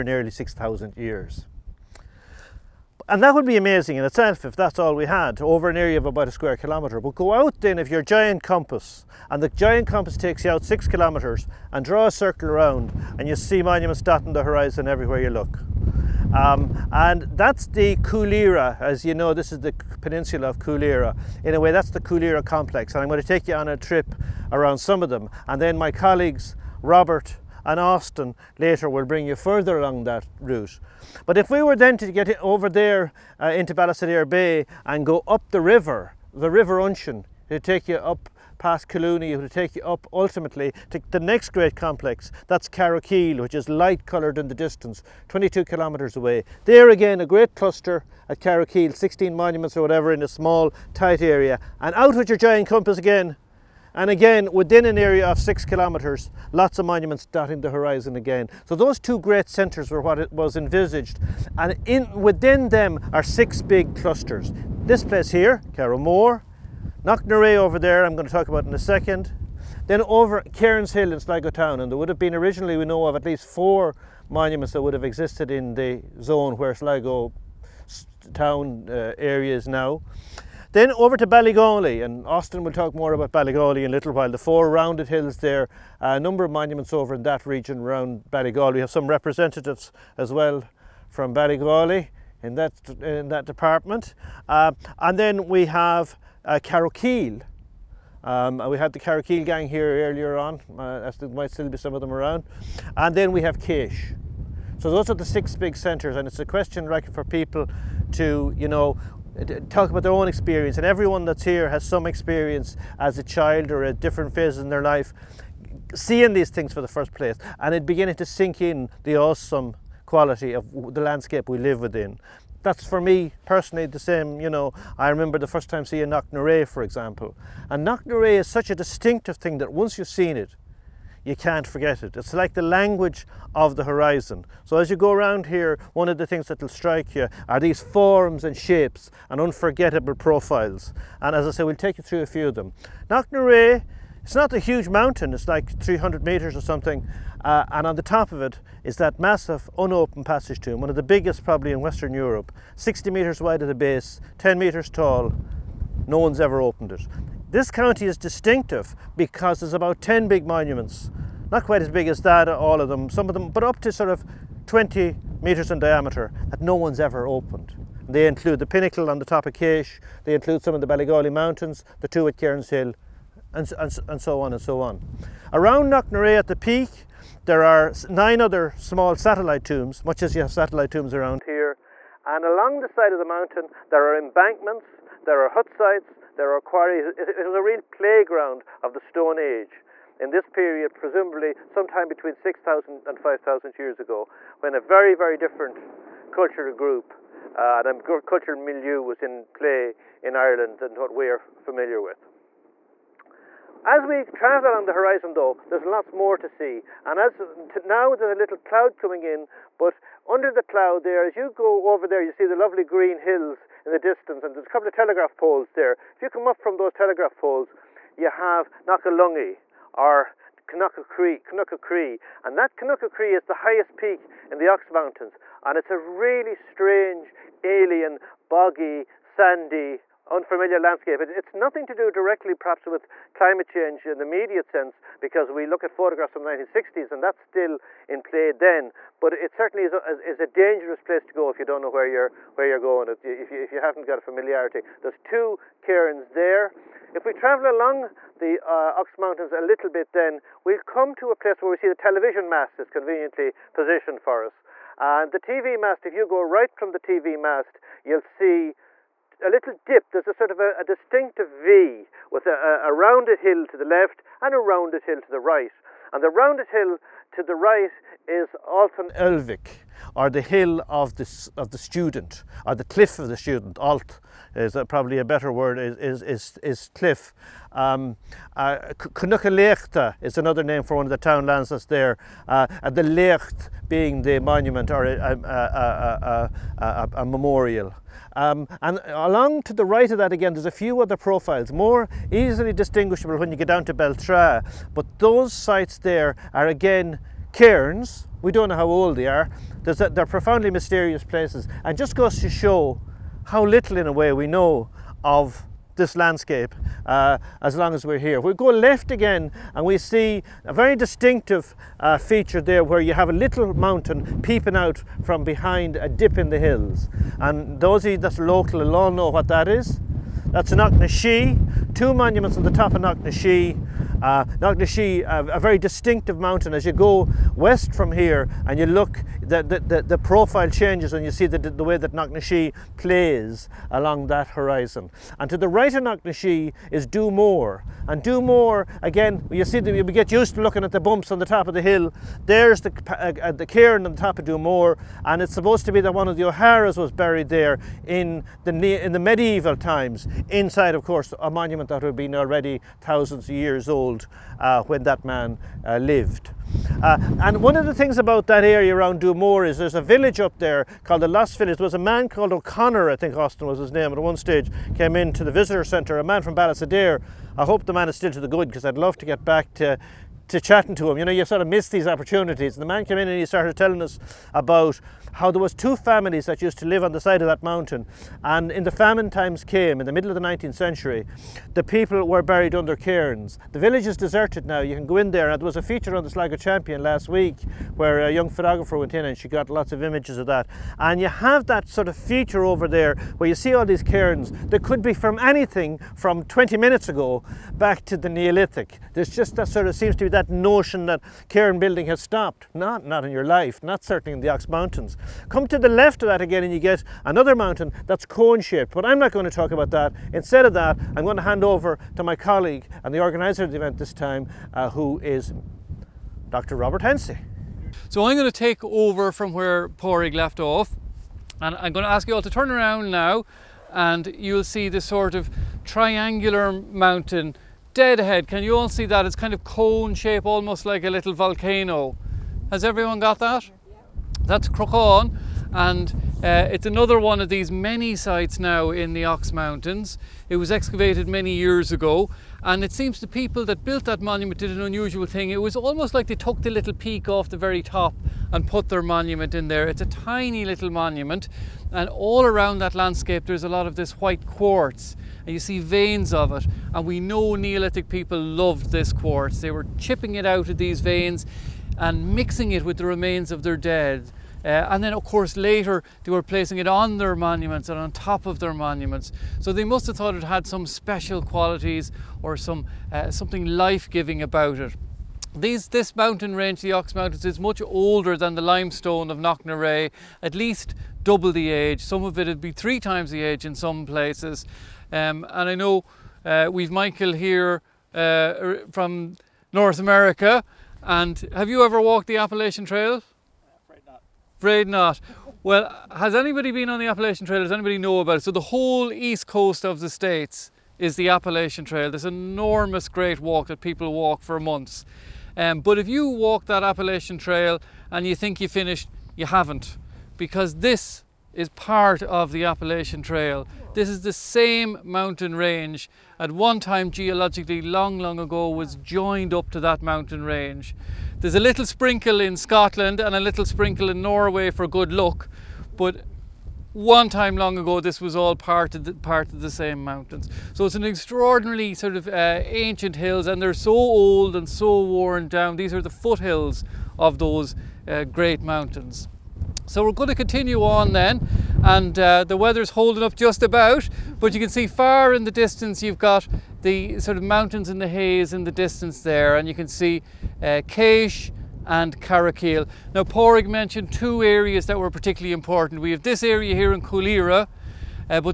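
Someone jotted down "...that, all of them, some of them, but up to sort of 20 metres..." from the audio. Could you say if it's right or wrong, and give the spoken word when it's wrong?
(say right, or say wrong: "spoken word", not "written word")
right.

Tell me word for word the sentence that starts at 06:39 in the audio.
There's just that sort of seems to be that notion that cairn building has stopped.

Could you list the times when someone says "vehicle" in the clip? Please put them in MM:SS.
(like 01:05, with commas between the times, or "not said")
not said.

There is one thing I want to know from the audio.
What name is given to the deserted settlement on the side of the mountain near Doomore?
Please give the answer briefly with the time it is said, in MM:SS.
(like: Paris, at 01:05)
The Lost Village, at 06:01.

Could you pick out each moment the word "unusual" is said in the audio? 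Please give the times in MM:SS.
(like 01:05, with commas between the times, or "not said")
07:24.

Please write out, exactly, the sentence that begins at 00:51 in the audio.
And out with your giant compass again, and again, within an area of six kilometres, lots of monuments dotting the horizon again.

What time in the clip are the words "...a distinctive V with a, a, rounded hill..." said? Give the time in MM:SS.
04:20.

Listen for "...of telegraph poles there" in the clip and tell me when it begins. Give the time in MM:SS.
03:34.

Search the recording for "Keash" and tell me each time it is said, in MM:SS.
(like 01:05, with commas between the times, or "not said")
01:43, 02:49, 09:10.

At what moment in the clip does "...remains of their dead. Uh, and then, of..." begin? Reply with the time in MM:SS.
07:43.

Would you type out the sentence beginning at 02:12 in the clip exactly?
It's like the language of the horizon.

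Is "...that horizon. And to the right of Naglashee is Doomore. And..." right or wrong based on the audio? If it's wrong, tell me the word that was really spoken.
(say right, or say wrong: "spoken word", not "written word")
right.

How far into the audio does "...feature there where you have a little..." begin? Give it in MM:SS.
05:12.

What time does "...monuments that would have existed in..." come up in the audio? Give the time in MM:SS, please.
01:14.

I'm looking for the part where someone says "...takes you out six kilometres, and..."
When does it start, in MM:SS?
00:10.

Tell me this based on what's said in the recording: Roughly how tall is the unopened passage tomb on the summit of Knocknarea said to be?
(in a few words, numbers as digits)
10 meters.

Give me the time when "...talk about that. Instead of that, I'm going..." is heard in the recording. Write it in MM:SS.
06:49.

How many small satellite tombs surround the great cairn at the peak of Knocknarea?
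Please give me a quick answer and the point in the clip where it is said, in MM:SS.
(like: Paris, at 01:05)
9, at 02:58.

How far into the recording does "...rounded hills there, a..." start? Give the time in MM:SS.
01:24.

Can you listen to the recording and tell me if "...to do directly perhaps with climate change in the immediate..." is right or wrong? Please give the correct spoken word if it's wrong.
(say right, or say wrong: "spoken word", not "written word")
right.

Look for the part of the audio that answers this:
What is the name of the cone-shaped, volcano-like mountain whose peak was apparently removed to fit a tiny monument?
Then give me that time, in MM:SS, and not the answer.
07:14.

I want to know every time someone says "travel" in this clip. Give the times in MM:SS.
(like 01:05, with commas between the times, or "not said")
03:24, 04:07.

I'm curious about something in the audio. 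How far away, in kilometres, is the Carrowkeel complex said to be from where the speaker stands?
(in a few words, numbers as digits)
22.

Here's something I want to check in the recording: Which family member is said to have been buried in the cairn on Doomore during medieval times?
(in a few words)
One of the O'Haras.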